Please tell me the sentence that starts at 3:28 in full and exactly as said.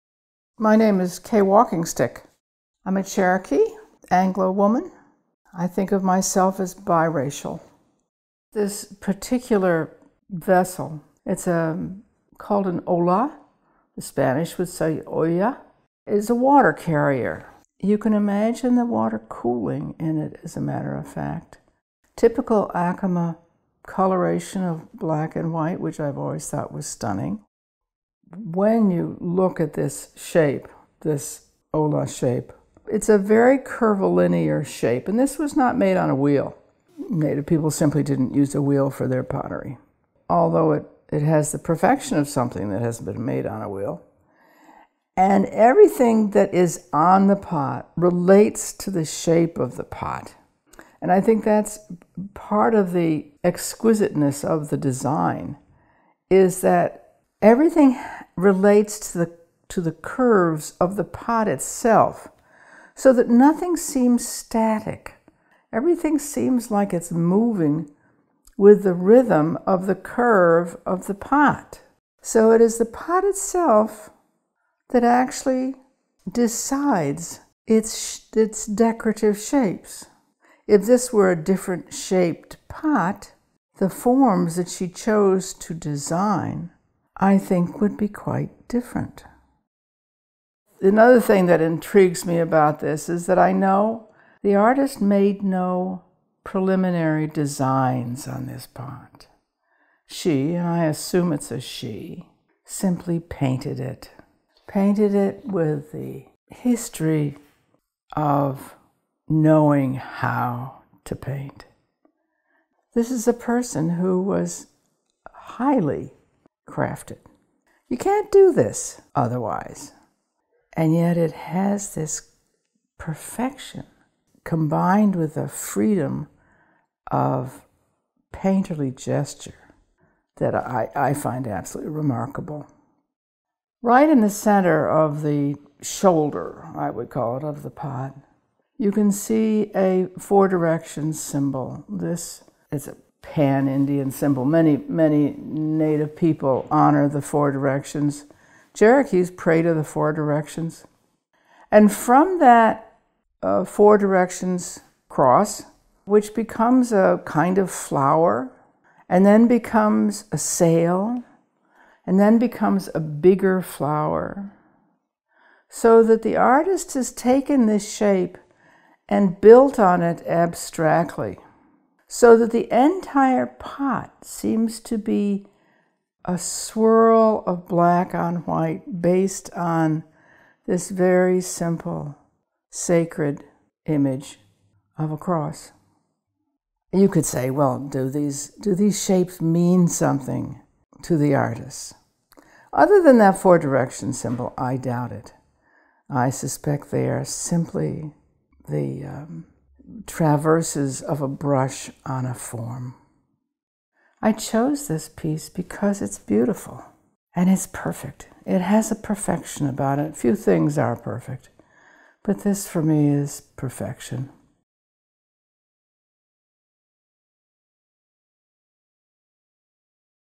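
It has a perfection about it.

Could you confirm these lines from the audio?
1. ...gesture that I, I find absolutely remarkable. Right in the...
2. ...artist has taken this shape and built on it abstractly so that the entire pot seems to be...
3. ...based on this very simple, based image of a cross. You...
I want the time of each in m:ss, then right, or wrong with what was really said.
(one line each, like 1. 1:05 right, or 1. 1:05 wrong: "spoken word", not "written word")
1. 2:08 right
2. 2:46 right
3. 2:59 wrong: "sacred", not "based".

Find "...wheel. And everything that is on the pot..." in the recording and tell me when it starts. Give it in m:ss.
0:43.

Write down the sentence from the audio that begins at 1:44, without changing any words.
Painted it with the history of knowing how to paint.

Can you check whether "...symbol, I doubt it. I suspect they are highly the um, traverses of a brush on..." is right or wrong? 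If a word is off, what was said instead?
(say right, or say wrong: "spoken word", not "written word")
wrong: "simply", not "highly".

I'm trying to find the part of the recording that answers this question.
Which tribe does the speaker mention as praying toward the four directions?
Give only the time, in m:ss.
2:28.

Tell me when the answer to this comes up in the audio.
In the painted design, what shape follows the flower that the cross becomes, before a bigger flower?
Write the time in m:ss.
2:40.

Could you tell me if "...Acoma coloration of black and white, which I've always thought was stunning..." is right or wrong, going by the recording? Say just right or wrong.
right.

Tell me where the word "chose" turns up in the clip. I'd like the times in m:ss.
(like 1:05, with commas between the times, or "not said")
1:24, 3:24.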